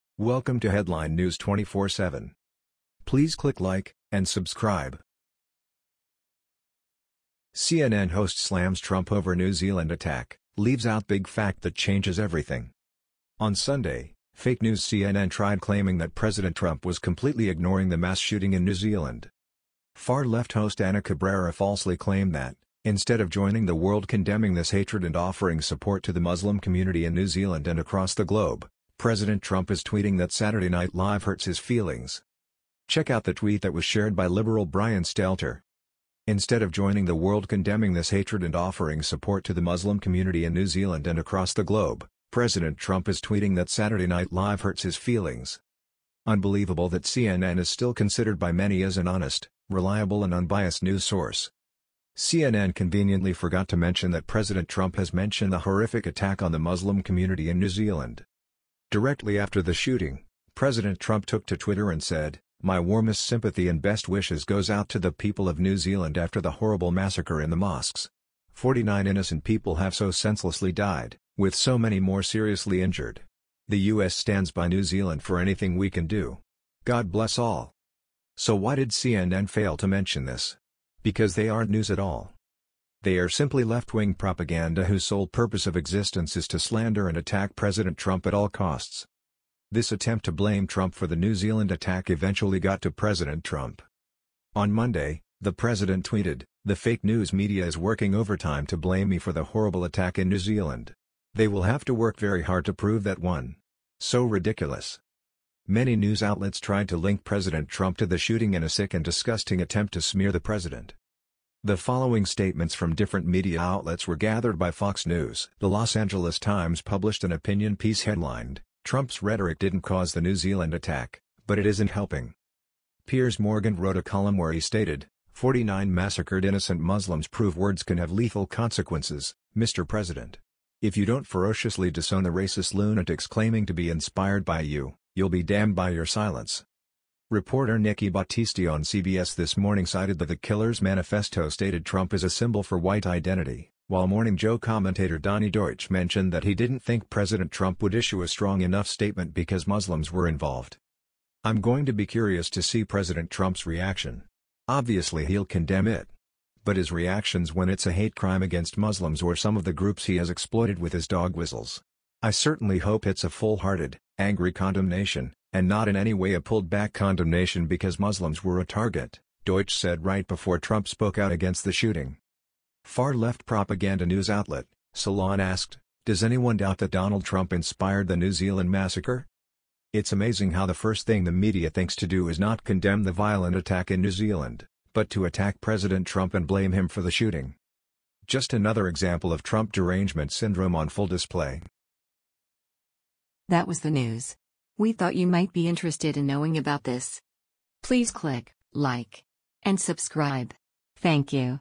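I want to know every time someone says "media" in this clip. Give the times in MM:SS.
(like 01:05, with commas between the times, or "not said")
01:37, 01:53, 03:01.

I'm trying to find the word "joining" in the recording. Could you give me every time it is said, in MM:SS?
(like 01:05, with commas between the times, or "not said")
00:23, 00:36.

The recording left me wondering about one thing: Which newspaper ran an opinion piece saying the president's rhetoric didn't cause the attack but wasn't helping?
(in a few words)
Los Angeles Times.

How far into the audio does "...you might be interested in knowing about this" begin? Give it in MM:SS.
03:15.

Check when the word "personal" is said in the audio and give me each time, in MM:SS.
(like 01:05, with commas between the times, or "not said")
not said.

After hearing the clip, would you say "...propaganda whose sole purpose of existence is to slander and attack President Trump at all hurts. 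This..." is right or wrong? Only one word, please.
wrong.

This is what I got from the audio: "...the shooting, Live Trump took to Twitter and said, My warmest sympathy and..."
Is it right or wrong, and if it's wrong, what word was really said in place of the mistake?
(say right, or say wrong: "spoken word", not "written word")
wrong: "President", not "Live".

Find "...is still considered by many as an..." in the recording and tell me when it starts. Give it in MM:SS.
00:47.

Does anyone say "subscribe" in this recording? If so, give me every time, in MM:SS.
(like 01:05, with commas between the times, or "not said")
00:04, 03:19.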